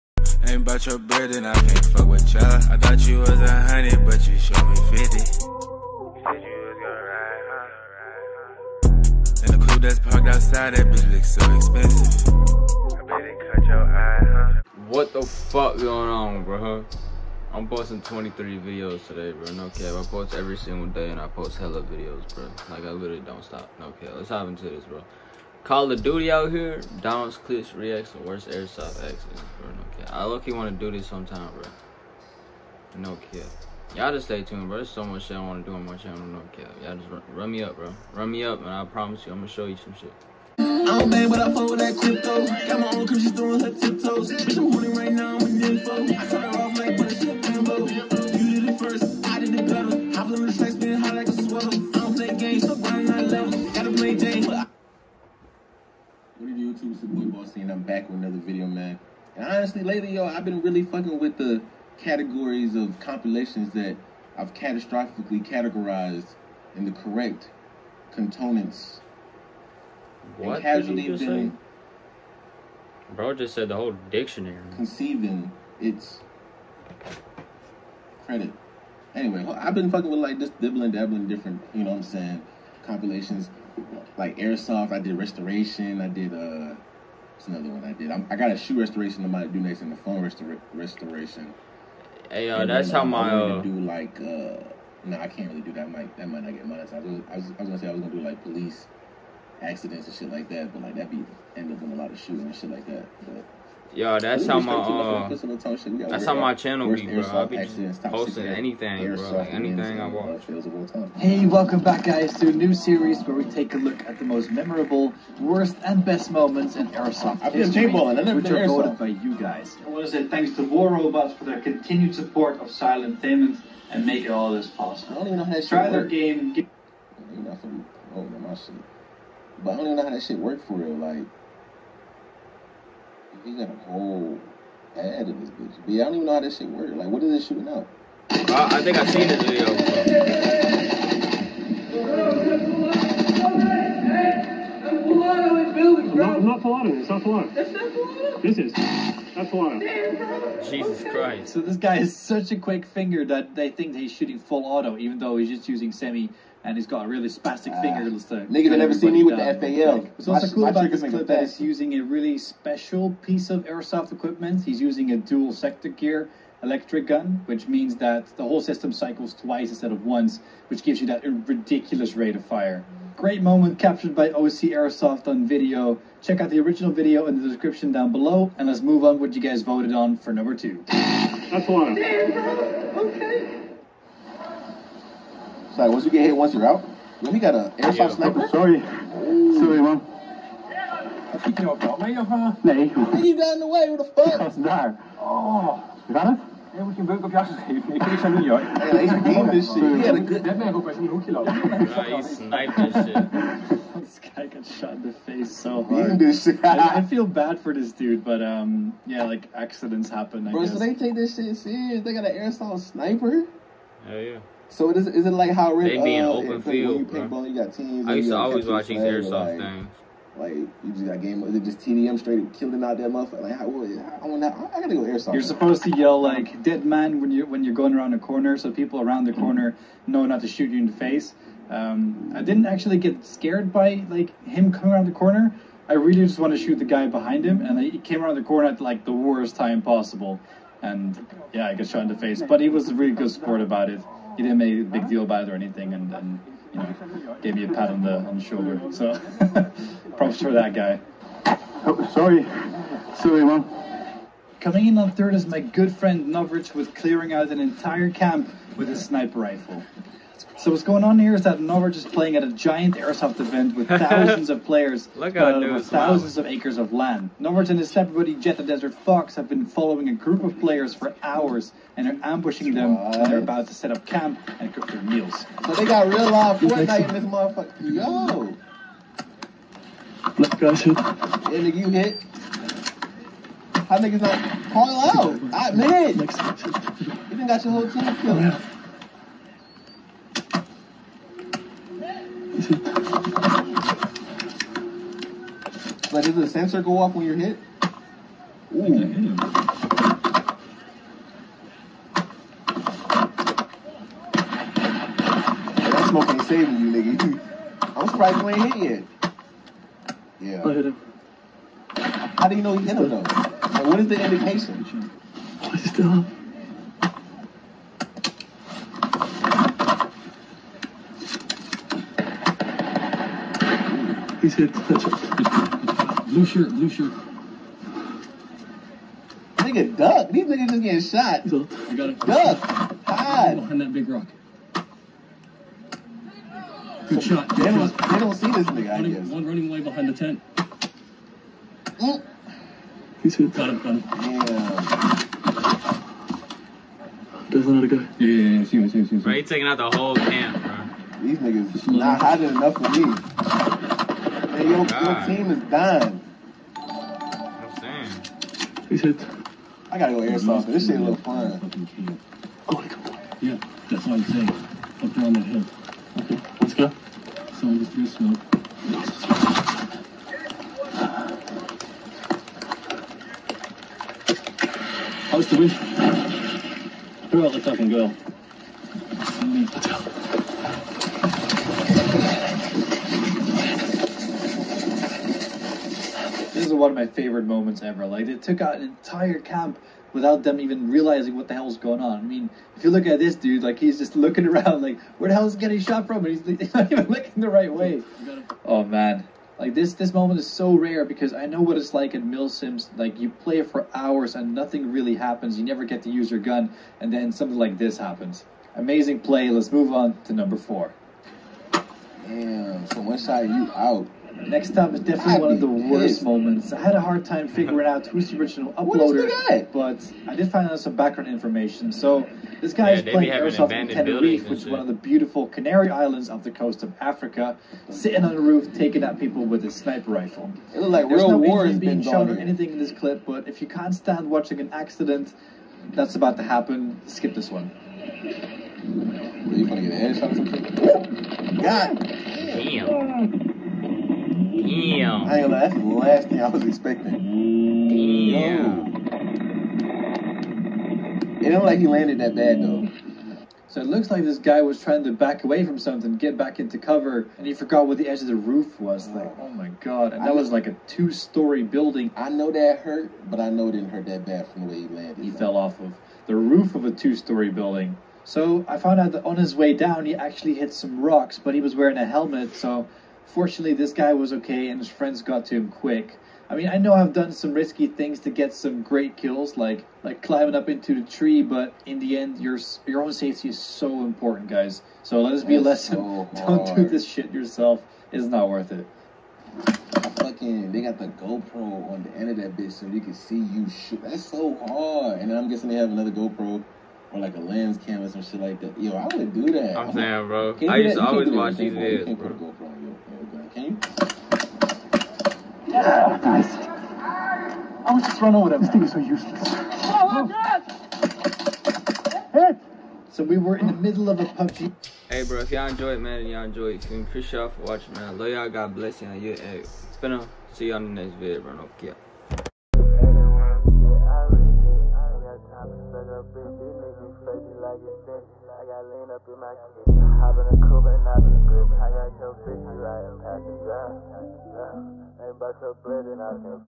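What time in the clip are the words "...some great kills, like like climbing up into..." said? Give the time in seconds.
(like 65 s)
478 s.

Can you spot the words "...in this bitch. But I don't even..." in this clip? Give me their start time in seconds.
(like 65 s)
135 s.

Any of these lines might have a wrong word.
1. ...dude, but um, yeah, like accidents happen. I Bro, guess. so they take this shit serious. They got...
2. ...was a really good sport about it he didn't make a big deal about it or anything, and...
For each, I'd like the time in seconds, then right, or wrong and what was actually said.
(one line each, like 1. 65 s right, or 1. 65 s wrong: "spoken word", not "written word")
1. 207 s right
2. 242 s right.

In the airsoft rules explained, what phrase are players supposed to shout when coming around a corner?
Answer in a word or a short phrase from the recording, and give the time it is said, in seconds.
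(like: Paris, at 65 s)
dead man, at 226 s.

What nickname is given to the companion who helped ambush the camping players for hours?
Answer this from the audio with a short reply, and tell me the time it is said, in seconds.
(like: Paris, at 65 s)
the Desert Fox, at 268 s.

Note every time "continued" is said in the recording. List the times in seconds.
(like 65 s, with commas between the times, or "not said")
121 s.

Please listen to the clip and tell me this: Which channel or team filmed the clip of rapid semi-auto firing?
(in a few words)
OC Airsoft.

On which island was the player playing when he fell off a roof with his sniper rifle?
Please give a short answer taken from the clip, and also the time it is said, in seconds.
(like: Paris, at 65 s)
Tenerife, at 423 s.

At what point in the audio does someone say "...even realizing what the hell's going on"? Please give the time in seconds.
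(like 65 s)
390 s.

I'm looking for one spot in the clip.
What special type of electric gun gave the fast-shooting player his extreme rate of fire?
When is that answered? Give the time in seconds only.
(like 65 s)
165 s.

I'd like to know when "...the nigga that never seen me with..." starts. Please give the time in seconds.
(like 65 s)
158 s.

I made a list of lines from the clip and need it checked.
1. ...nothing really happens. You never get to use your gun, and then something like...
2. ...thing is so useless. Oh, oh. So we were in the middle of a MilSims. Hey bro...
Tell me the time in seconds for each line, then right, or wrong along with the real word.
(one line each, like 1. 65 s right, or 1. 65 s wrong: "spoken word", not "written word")
1. 404 s right
2. 508 s wrong: "PUBG", not "MilSims".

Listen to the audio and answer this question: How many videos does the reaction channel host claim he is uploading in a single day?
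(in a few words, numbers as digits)
23.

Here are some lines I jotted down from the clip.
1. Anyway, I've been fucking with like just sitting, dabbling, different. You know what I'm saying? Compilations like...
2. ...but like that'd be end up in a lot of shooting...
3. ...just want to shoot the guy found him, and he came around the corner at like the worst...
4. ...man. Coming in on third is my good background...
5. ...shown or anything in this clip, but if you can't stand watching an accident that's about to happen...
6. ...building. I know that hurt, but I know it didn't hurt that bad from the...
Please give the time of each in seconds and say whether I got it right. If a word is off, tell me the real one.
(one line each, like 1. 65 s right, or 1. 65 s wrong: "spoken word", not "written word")
1. 79 s wrong: "dibbling", not "sitting"
2. 100 s right
3. 236 s wrong: "behind", not "found"
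4. 253 s wrong: "friend", not "background"
5. 432 s right
6. 461 s right.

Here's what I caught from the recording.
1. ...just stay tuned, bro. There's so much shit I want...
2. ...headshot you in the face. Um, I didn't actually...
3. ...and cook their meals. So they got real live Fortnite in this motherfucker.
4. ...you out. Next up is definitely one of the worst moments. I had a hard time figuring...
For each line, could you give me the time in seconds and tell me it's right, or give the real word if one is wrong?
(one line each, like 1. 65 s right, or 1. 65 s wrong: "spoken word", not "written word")
1. 34 s right
2. 230 s wrong: "shoot", not "headshot"
3. 274 s right
4. 413 s right.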